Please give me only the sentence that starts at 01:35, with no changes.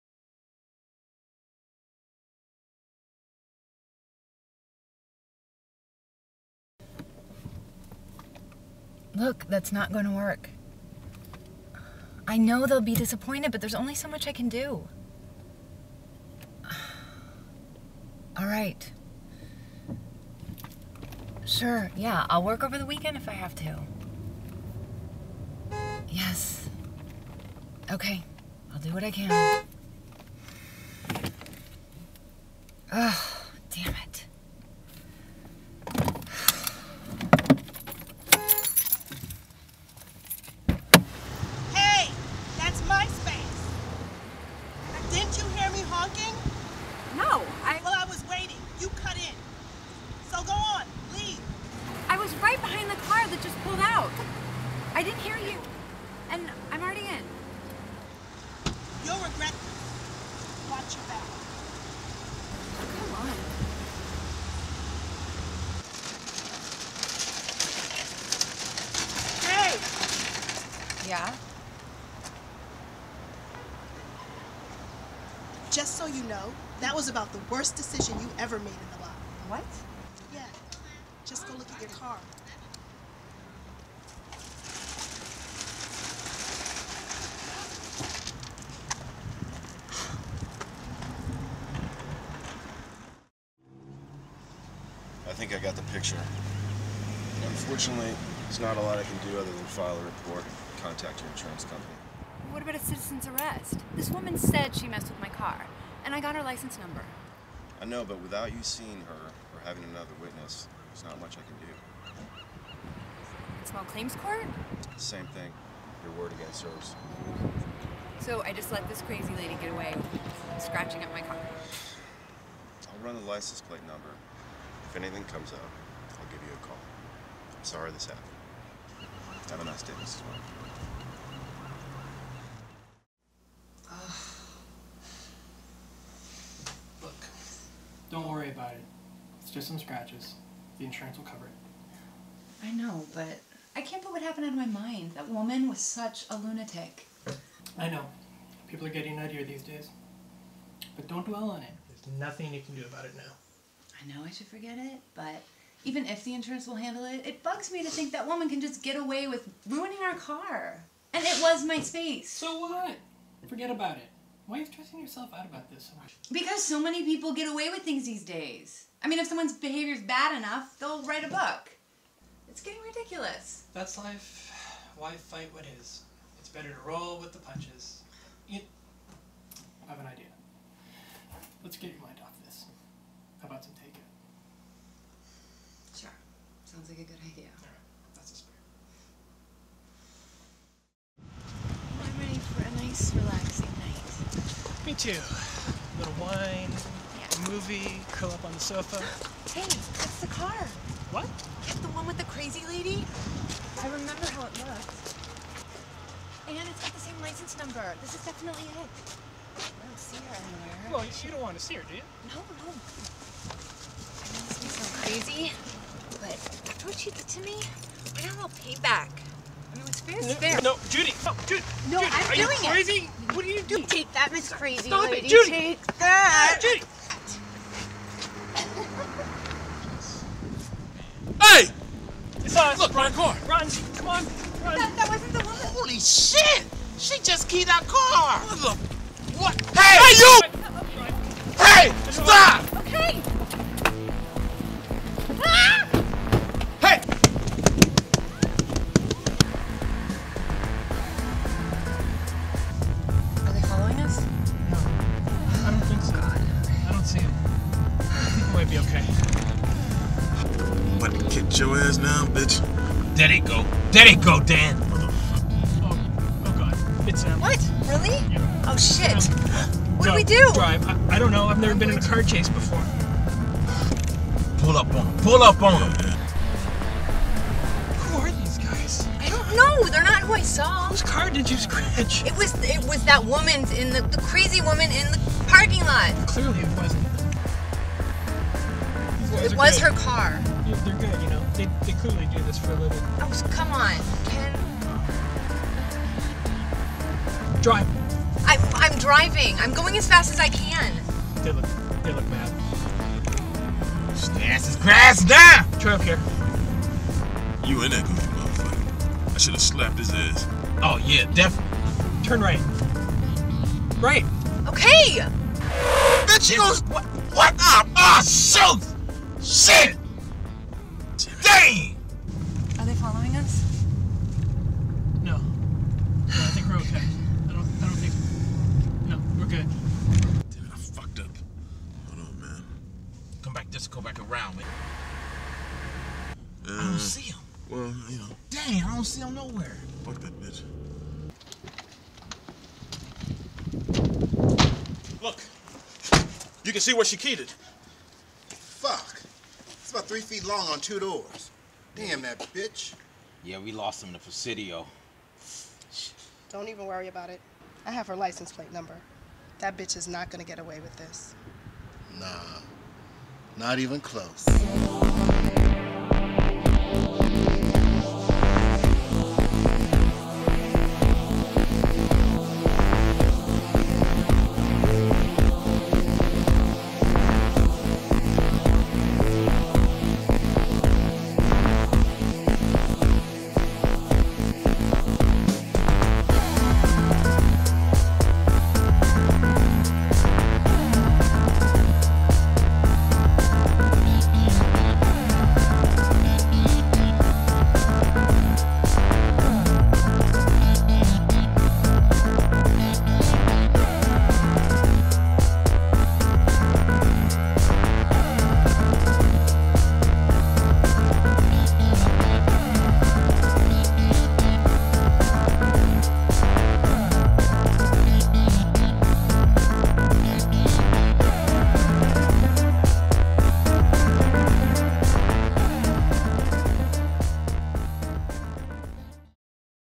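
I think I got the picture.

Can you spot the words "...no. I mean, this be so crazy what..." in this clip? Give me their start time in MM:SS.
03:32.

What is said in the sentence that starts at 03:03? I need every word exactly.
How about some Sounds like a good idea.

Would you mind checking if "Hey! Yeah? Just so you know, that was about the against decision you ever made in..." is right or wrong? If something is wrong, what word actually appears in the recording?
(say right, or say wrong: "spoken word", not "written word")
wrong: "worst", not "against".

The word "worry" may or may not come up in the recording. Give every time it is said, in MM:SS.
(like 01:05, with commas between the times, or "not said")
02:18, 05:56.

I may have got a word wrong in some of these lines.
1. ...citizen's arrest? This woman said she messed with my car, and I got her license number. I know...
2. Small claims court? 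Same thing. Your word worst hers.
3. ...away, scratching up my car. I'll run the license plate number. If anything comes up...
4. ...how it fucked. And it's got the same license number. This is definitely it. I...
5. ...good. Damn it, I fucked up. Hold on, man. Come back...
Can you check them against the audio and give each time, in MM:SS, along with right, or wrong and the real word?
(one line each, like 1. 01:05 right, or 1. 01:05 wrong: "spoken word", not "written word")
1. 01:42 right
2. 01:53 wrong: "against", not "worst"
3. 01:59 right
4. 03:24 wrong: "looked", not "fucked"
5. 05:29 right.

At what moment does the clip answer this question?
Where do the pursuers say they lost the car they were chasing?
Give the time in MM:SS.
05:54.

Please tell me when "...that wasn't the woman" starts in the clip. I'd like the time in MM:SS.
03:54.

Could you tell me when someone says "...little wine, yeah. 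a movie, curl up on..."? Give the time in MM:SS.
03:15.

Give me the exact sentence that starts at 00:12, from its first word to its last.
I know they'll be disappointed, but there's only so much I can do.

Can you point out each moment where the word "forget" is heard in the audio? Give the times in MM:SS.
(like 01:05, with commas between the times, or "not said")
02:34, 02:43.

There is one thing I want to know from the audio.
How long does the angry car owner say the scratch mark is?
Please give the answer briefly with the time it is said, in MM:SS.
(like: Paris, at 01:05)
3 feet, at 05:50.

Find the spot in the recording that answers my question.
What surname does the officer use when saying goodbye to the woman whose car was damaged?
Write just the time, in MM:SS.
02:10.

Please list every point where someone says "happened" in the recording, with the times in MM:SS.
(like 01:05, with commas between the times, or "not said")
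02:08, 02:24.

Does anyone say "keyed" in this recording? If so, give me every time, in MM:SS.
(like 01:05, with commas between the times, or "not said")
03:57, 05:47.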